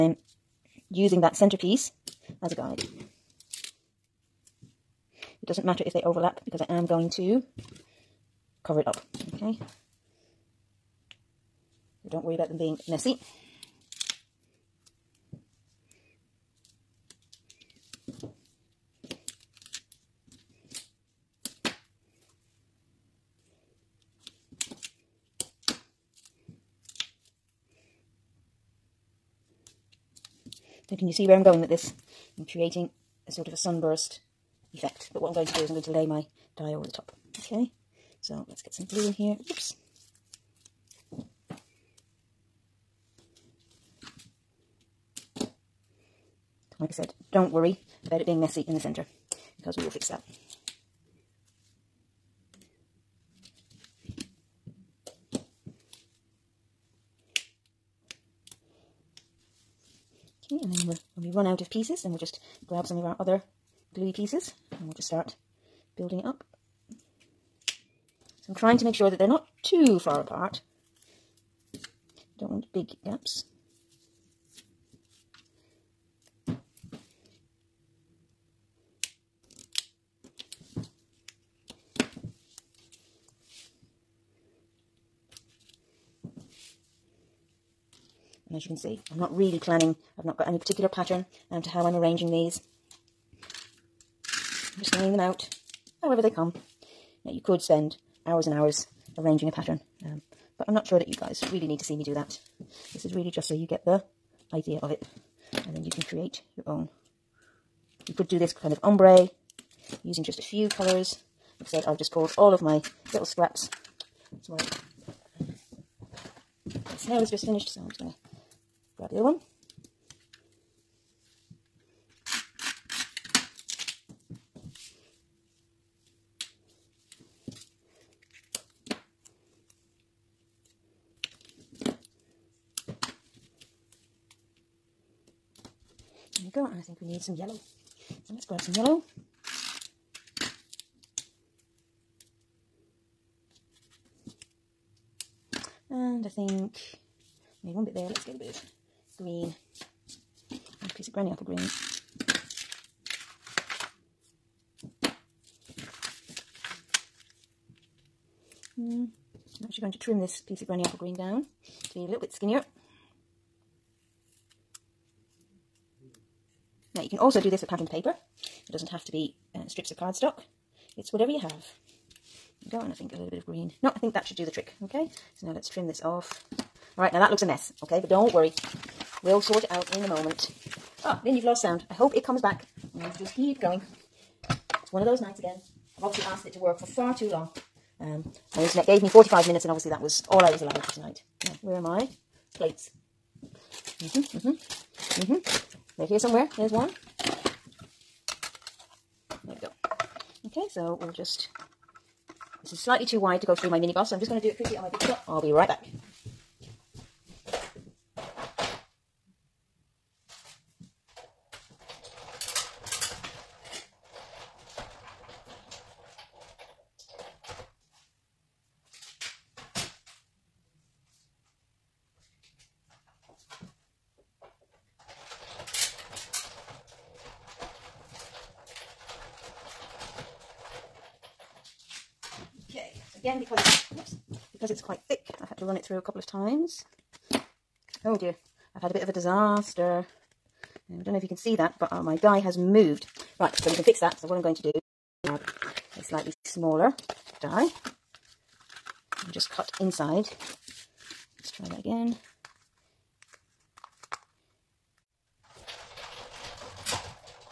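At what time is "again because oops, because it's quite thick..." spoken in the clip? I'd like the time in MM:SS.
03:53.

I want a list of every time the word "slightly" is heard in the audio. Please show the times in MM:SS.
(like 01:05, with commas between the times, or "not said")
03:22, 04:06.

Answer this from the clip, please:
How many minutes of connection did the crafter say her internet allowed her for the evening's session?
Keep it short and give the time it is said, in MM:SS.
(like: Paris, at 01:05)
45, at 03:09.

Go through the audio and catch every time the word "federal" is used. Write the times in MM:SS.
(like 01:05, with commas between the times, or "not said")
not said.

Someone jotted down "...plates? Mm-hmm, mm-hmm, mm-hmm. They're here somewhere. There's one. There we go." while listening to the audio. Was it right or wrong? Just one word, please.
right.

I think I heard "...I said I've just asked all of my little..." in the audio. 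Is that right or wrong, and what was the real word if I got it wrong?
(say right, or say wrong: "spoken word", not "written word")
wrong: "pulled", not "asked".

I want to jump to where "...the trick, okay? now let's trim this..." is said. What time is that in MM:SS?
02:54.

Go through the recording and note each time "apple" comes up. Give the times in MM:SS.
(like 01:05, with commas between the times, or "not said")
02:31, 02:40.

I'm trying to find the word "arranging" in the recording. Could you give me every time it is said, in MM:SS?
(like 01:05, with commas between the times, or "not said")
01:31, 01:39.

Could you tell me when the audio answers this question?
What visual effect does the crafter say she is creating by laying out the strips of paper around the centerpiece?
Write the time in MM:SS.
00:33.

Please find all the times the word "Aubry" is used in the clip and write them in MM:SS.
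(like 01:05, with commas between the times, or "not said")
not said.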